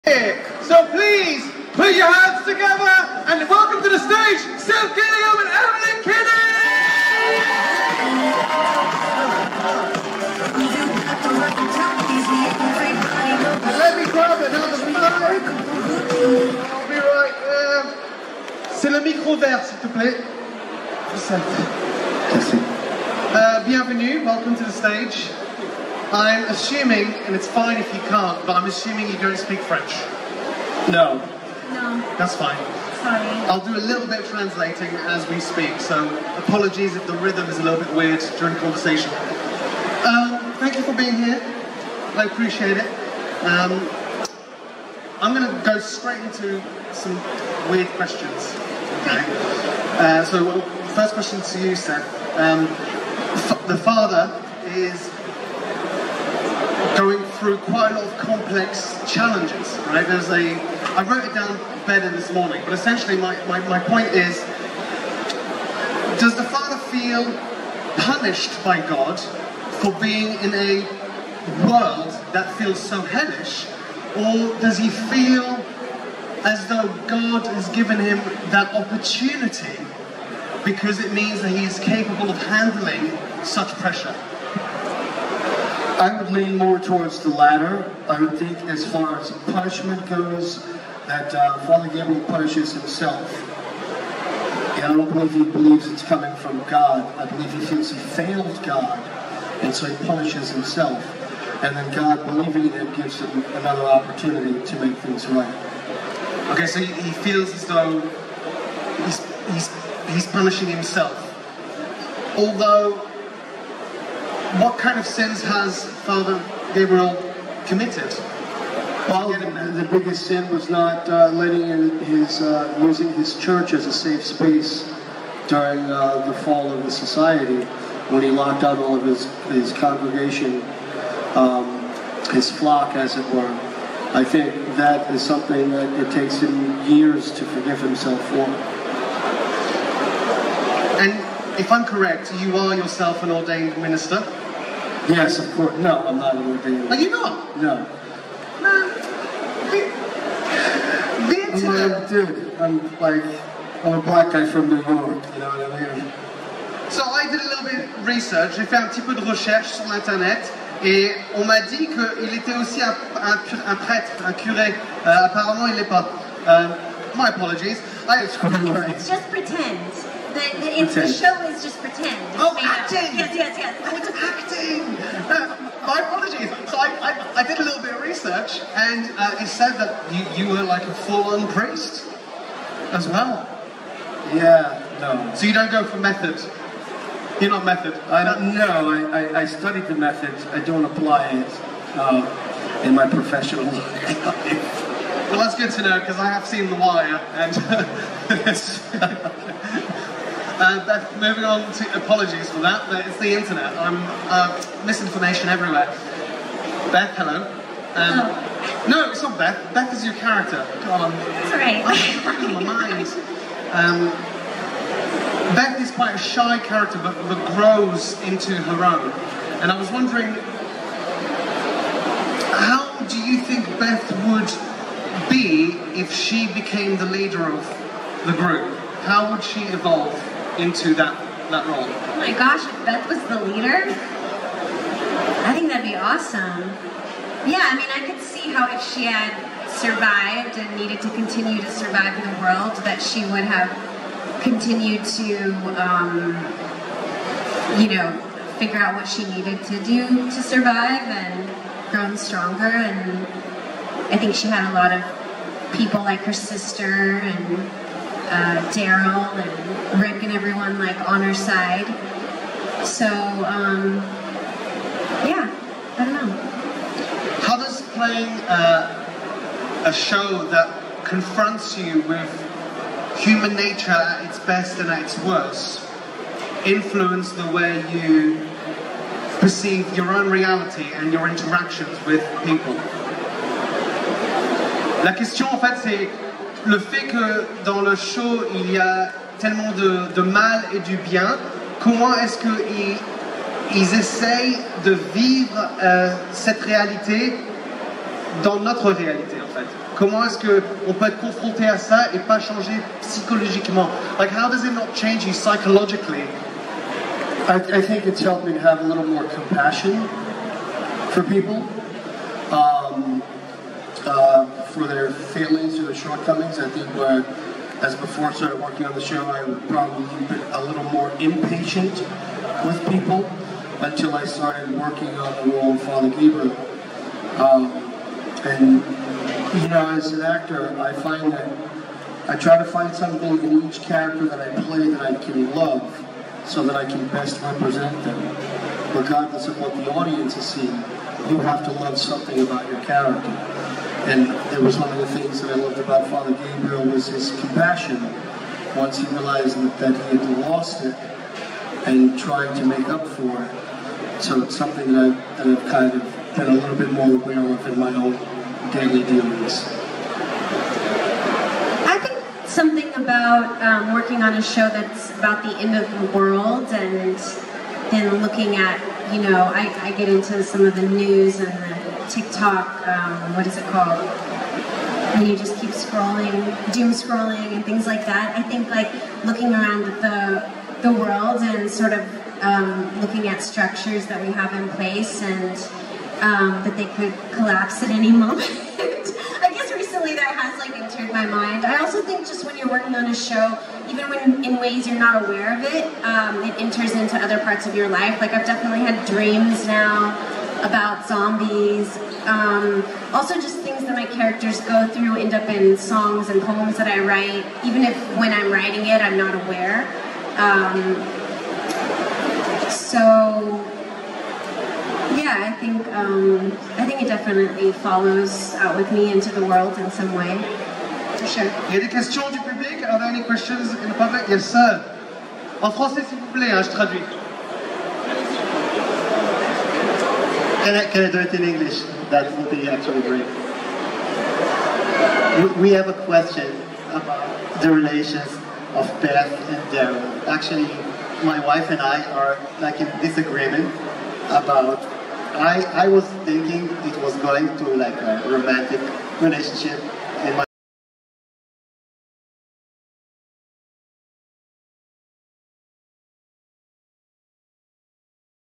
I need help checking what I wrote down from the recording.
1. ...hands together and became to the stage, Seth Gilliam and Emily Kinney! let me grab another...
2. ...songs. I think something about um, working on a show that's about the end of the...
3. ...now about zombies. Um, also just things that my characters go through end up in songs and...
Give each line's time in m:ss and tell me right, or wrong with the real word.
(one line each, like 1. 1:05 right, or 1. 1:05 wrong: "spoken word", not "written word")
1. 0:02 wrong: "welcome", not "became"
2. 5:59 wrong: "dealings", not "songs"
3. 6:39 right.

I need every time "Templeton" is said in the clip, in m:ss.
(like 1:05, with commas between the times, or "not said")
not said.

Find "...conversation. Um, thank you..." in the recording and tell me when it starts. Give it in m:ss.
0:38.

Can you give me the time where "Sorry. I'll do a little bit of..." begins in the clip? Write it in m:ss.
0:32.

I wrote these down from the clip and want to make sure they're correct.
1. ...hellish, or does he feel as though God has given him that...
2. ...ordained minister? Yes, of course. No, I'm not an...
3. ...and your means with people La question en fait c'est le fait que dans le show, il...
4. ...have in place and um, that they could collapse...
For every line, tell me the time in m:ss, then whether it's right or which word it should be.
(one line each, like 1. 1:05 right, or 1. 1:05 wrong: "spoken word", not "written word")
1. 1:13 right
2. 2:23 right
3. 4:40 wrong: "interactions", not "means"
4. 6:24 right.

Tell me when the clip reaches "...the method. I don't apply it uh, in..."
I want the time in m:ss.
3:09.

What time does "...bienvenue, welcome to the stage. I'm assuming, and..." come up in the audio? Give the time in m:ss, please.
0:23.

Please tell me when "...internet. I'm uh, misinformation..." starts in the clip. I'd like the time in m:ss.
3:23.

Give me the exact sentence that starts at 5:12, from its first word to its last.
Um, uh, for their failings or their shortcomings.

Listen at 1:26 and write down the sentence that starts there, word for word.
I would lean more towards the latter.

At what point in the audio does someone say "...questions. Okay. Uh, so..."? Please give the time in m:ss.
0:47.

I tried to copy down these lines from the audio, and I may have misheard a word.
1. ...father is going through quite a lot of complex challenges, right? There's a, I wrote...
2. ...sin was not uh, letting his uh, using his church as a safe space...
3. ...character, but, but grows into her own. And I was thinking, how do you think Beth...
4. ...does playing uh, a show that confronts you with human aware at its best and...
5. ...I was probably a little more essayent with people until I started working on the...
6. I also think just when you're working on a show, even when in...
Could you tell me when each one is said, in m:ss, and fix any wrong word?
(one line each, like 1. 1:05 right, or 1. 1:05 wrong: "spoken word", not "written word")
1. 0:53 right
2. 2:00 right
3. 3:36 wrong: "wondering", not "thinking"
4. 4:27 wrong: "nature", not "aware"
5. 5:19 wrong: "impatient", not "essayent"
6. 6:31 right.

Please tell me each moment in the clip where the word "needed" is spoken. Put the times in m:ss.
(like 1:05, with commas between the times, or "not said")
4:00, 4:09.